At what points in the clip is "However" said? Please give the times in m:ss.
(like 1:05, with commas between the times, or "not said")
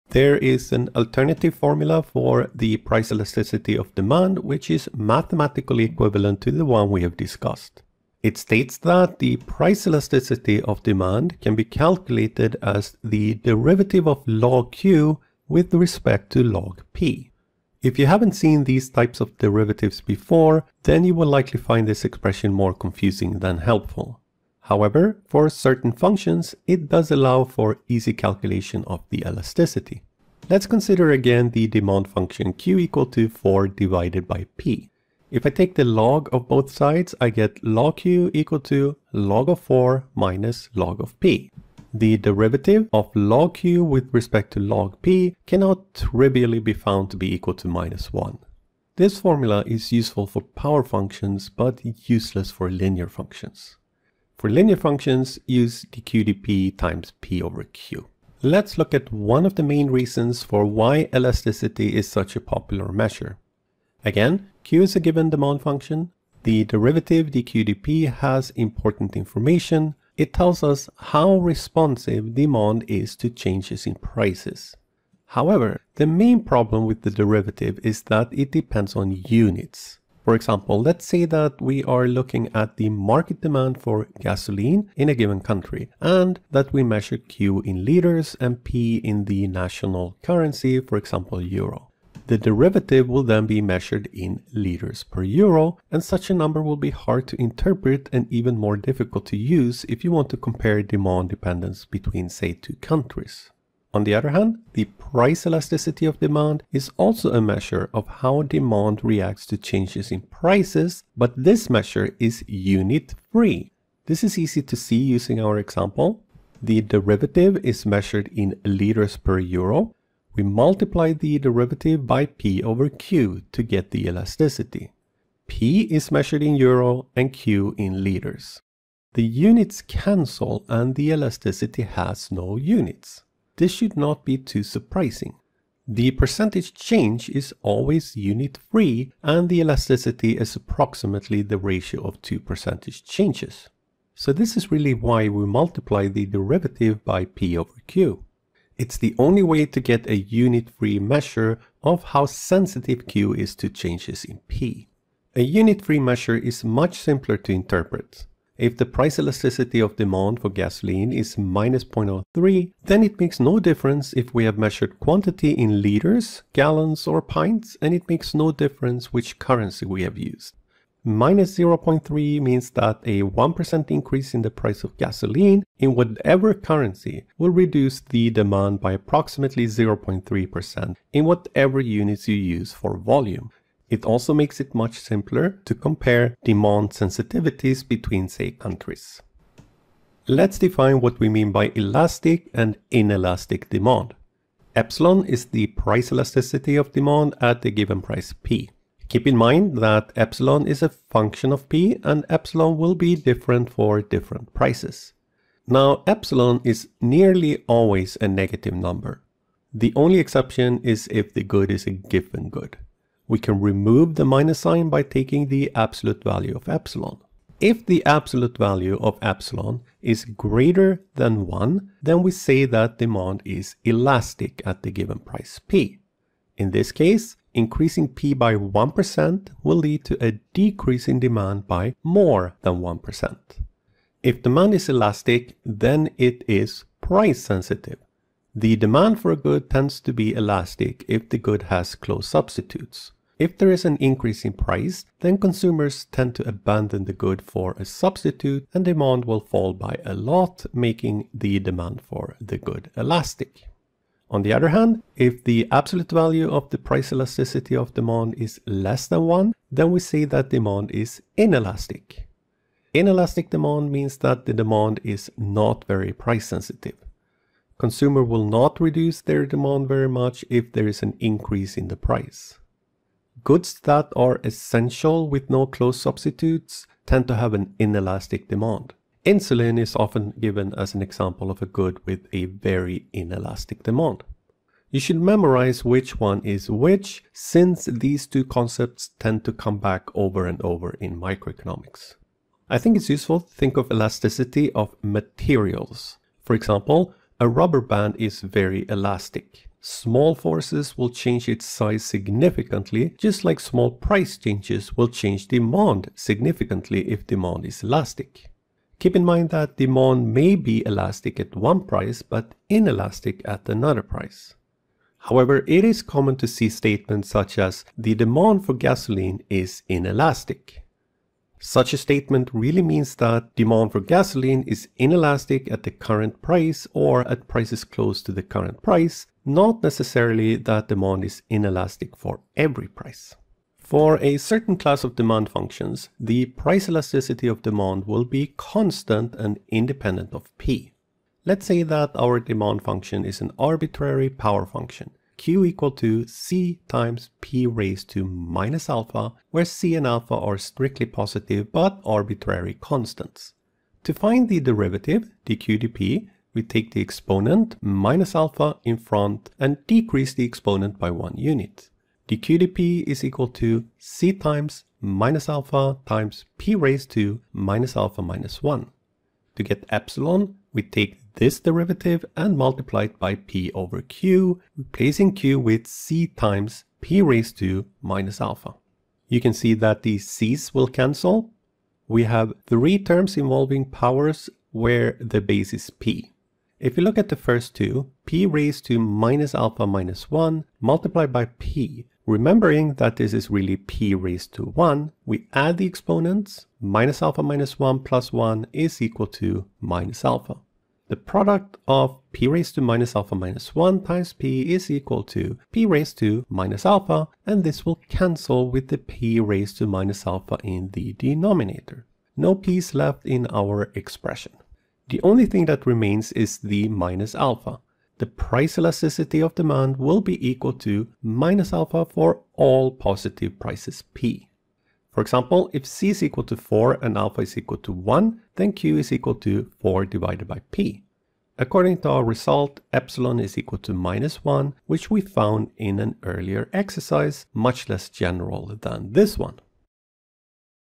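0:24, 1:15, 5:15.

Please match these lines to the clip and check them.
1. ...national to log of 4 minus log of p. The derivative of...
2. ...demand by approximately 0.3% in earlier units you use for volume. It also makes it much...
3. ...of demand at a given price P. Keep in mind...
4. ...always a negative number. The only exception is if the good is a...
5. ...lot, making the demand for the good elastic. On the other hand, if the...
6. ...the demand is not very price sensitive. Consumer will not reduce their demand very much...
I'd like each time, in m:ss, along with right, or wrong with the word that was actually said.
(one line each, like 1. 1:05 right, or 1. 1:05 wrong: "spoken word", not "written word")
1. 0:38 wrong: "equal", not "national"
2. 2:58 wrong: "whatever", not "earlier"
3. 3:16 right
4. 3:27 right
5. 4:10 right
6. 4:24 right.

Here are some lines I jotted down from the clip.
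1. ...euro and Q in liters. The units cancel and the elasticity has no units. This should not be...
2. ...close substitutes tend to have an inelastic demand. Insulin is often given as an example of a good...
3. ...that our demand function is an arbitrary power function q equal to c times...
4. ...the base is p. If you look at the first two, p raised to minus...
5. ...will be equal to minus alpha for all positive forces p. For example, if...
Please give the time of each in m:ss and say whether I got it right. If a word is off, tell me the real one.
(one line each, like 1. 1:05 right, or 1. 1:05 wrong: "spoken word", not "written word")
1. 2:06 right
2. 4:35 right
3. 5:41 right
4. 6:25 right
5. 6:59 wrong: "prices", not "forces".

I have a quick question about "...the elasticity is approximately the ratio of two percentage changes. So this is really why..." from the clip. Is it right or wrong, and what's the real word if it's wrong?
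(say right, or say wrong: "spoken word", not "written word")
right.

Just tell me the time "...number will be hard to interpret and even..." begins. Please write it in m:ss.
1:36.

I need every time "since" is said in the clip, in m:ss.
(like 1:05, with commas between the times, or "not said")
4:47.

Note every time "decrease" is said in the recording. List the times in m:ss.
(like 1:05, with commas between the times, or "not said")
3:50, 5:59.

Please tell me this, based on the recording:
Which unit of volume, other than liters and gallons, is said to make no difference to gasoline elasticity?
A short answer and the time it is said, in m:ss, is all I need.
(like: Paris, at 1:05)
pints, at 2:47.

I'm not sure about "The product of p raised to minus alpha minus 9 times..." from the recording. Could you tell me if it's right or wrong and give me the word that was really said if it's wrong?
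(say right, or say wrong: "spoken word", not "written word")
wrong: "1", not "9".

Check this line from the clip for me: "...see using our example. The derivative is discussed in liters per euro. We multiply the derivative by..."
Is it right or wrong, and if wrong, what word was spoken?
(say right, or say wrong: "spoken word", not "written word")
wrong: "measured", not "discussed".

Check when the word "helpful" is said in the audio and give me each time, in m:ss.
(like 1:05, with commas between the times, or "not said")
0:23.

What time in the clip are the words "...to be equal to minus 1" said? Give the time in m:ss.
0:47.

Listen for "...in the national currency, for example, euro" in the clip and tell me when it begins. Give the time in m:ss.
1:28.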